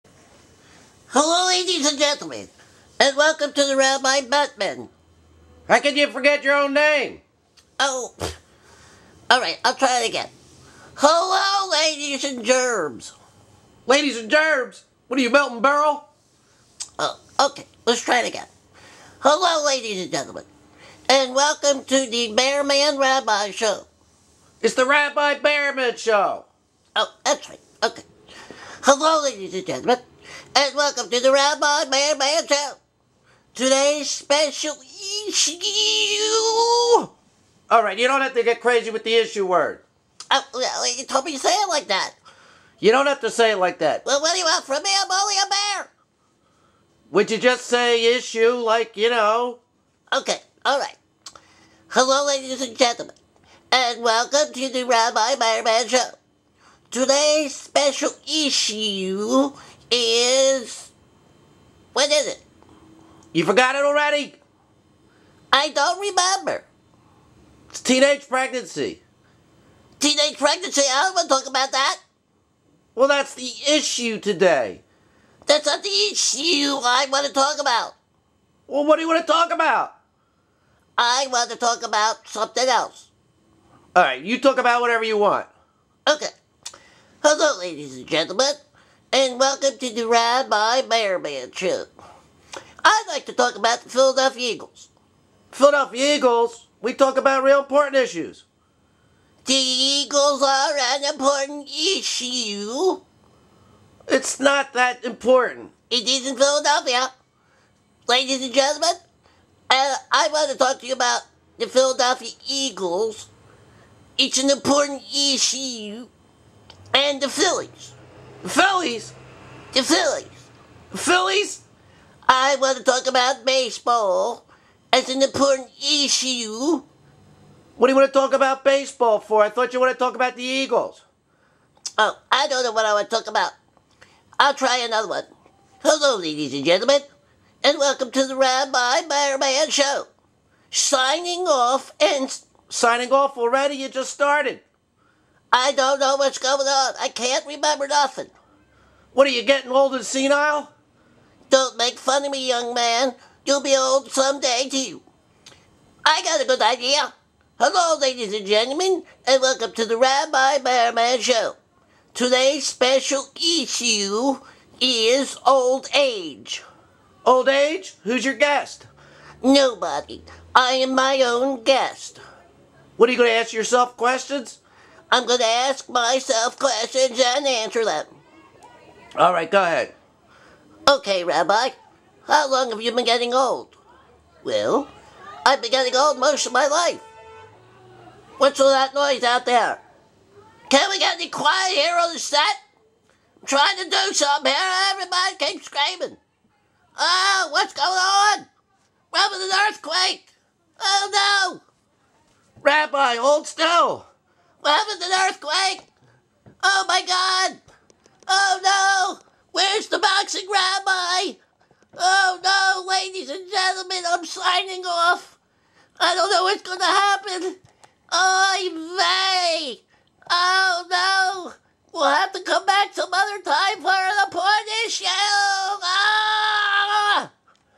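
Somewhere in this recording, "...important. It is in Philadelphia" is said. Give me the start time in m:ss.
1:45.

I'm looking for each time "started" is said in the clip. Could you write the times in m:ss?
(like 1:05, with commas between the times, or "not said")
2:24.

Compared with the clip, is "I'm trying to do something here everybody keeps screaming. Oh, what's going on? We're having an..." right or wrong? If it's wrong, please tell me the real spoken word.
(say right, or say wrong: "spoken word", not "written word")
right.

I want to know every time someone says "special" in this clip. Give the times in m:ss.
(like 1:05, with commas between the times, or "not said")
0:34, 0:57, 2:42.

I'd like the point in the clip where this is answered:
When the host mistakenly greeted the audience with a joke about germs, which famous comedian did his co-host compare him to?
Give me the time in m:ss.
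0:15.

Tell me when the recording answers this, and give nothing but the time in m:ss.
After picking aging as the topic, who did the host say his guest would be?
2:49.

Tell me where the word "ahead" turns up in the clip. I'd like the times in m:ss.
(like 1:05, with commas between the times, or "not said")
2:59.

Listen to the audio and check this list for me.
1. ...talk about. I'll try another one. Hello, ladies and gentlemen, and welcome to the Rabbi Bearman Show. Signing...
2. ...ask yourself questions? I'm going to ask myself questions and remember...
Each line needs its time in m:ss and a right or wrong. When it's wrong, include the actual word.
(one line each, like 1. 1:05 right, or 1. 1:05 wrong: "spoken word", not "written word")
1. 2:13 right
2. 2:53 wrong: "answer", not "remember".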